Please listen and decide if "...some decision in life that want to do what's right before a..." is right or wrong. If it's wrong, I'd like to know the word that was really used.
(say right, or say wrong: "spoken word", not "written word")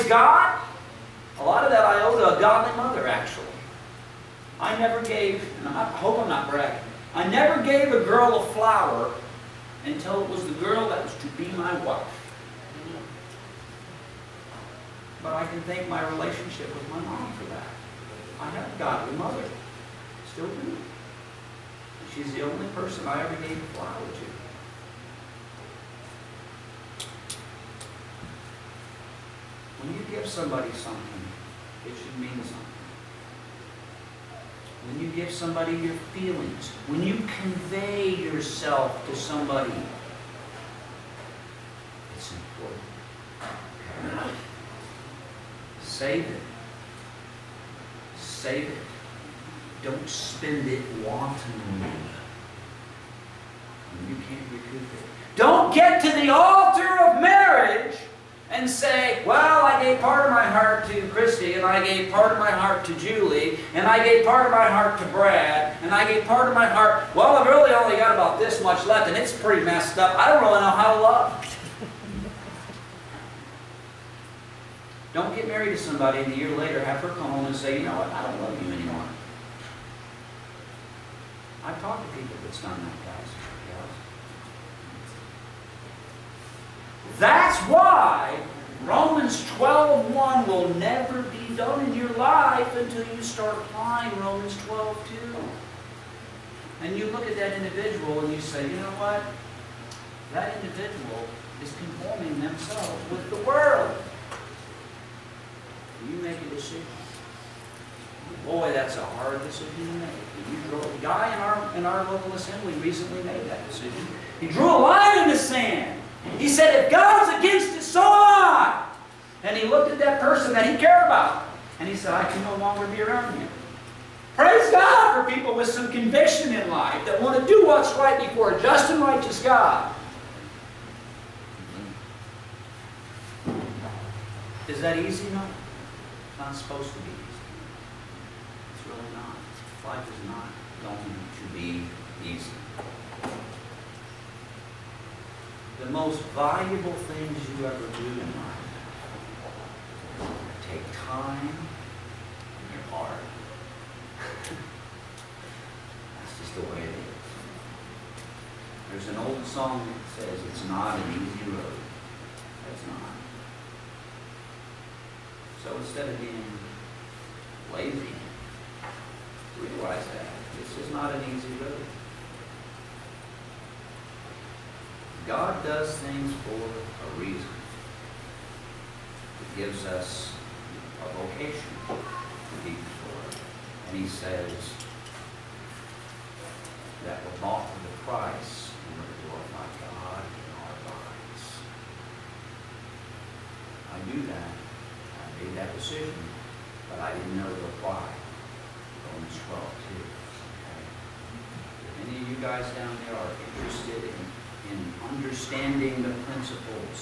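wrong: "conviction", not "decision".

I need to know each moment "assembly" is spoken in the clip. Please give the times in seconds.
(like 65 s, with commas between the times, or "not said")
112 s.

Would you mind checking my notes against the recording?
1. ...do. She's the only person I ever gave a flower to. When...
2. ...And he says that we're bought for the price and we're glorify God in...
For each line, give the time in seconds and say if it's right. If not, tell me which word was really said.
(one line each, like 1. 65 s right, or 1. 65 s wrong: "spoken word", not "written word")
1. 20 s right
2. 183 s right.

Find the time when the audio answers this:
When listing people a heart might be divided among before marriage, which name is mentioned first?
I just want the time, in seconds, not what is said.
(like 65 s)
61 s.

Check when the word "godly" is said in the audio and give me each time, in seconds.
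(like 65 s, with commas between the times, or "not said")
2 s, 18 s.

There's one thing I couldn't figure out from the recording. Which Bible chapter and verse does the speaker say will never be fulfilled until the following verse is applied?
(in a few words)
Romans 12:1.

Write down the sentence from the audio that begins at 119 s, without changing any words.
And he looked at that person that he cared about.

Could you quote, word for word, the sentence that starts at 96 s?
And you look at that individual and you say, you know what?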